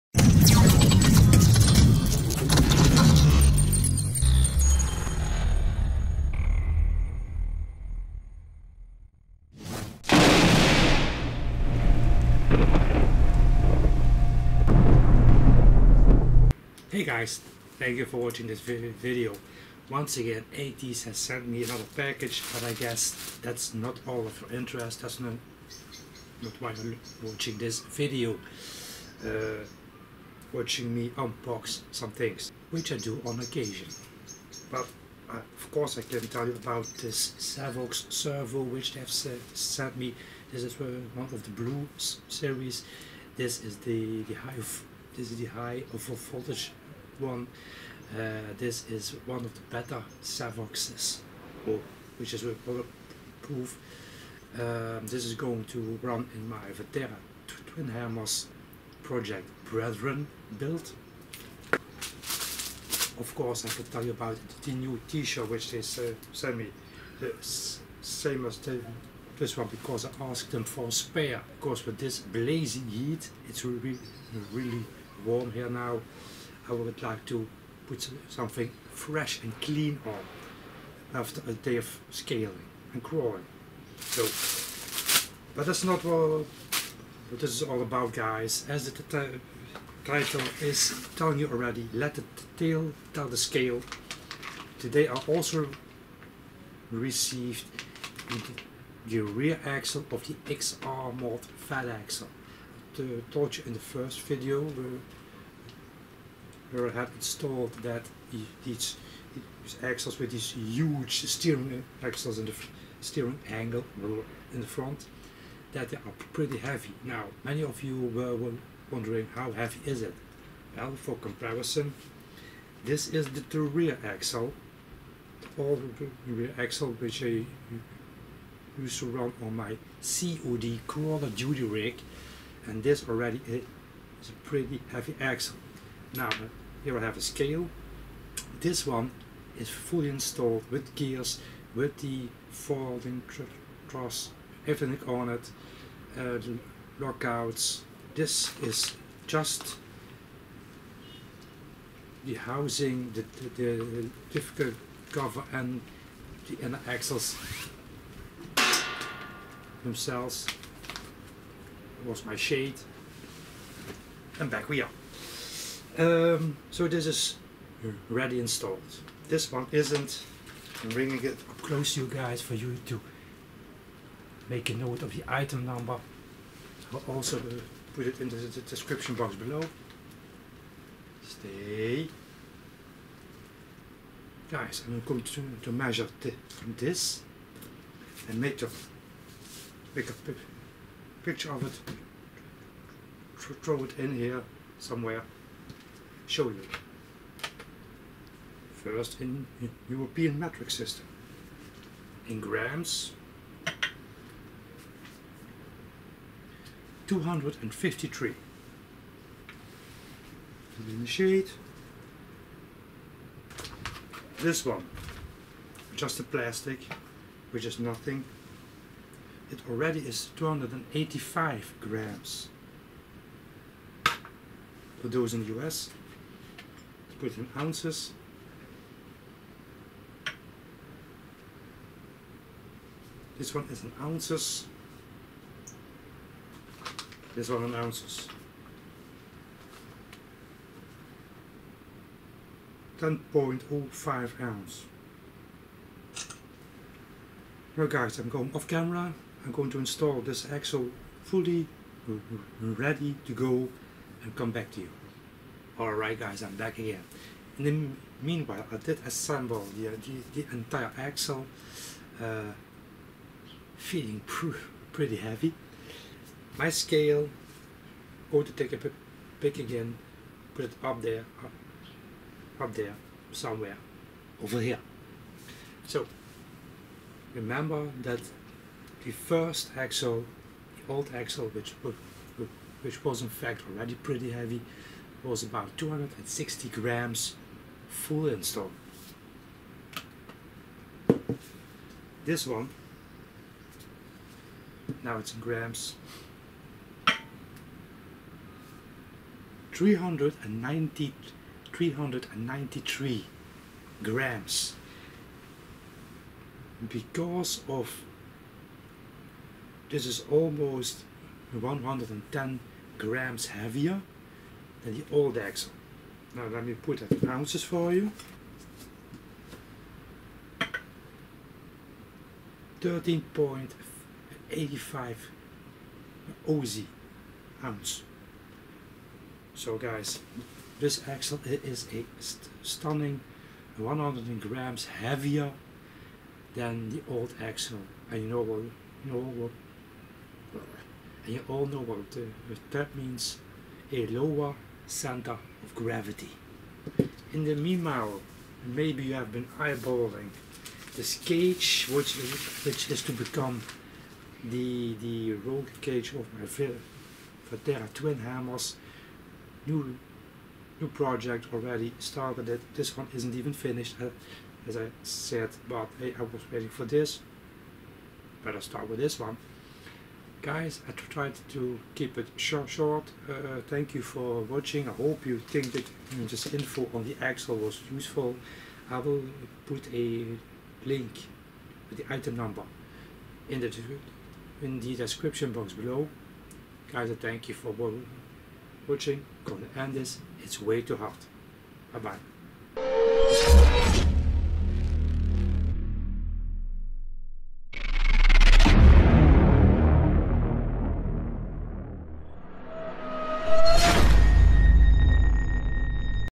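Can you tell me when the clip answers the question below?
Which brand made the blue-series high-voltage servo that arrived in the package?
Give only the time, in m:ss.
0:37.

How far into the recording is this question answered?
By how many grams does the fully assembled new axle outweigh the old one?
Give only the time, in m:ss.
5:33.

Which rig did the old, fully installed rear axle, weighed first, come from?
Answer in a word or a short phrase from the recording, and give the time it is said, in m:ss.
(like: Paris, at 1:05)
COD Crawler Duty, at 2:10.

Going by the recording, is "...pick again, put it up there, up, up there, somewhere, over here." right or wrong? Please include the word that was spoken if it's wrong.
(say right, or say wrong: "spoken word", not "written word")
right.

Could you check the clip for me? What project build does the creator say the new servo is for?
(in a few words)
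Brethren.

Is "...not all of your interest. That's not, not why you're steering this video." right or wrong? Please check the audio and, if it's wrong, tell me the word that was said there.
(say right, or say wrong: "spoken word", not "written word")
wrong: "watching", not "steering".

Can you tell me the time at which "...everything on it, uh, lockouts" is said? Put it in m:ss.
2:24.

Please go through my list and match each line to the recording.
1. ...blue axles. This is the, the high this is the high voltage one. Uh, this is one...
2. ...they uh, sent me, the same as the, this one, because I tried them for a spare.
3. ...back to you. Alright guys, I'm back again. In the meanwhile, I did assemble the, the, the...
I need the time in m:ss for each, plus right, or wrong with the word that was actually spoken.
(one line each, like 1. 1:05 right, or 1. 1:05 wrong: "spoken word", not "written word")
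1. 0:41 wrong: "series", not "axles"
2. 1:05 wrong: "asked", not "tried"
3. 4:14 right.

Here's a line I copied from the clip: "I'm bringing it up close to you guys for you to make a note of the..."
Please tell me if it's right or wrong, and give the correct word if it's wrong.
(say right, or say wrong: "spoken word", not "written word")
right.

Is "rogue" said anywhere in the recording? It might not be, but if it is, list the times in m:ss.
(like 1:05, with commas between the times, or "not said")
5:55.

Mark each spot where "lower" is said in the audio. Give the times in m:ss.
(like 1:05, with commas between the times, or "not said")
5:44.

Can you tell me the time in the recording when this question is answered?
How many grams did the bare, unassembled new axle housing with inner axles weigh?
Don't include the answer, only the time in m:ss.
3:40.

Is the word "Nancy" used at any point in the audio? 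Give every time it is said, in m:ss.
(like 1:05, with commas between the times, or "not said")
not said.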